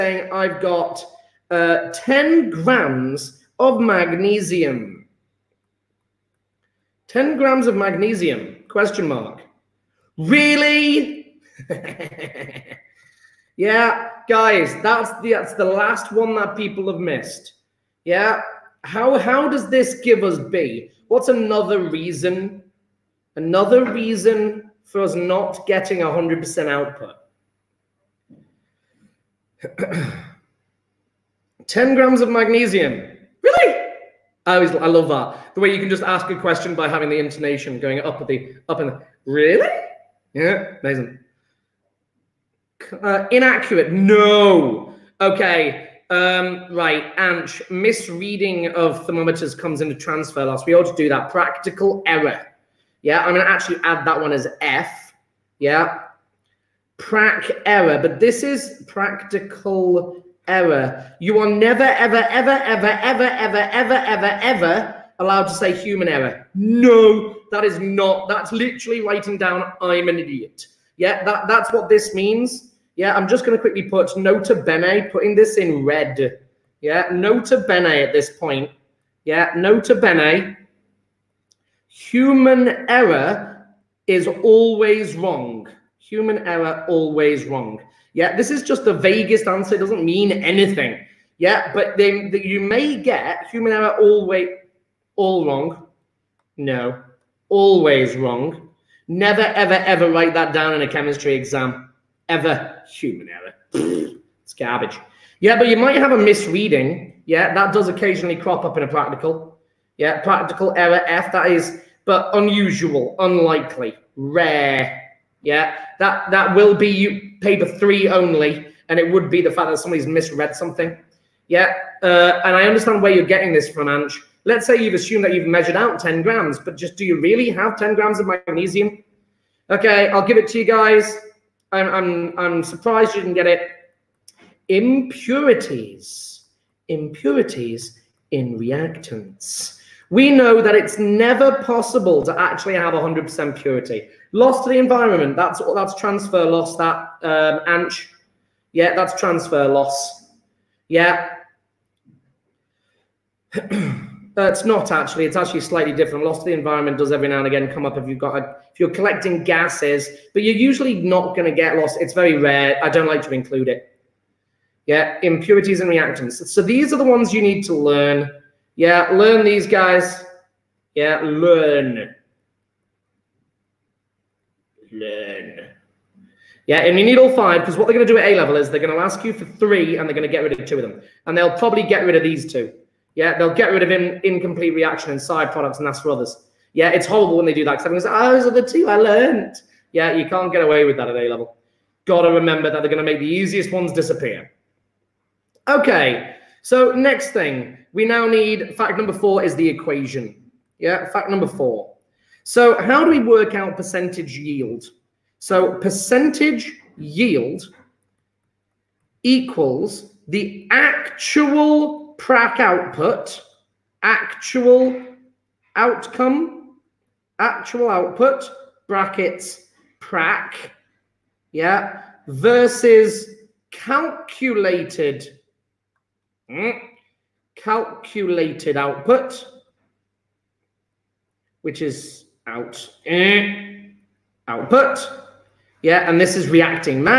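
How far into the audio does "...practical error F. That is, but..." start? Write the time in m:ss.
1:50.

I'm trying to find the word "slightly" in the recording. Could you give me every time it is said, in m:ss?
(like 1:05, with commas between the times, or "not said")
2:35.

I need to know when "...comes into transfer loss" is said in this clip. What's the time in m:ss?
0:49.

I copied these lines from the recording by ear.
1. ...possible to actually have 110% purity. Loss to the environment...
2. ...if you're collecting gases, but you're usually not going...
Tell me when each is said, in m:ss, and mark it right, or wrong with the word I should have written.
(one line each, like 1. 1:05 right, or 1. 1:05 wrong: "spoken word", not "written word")
1. 2:21 wrong: "100", not "110"
2. 2:38 right.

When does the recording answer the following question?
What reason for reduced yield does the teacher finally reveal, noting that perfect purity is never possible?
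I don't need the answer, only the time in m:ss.
2:16.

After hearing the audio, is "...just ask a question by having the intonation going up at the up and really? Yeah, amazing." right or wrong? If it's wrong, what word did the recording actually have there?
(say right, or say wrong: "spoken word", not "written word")
right.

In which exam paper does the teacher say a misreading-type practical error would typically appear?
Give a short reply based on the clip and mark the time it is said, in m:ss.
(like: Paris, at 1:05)
Paper three, at 1:57.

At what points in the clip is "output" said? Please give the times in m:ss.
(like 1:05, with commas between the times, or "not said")
0:26, 3:32, 3:37, 3:48, 3:54.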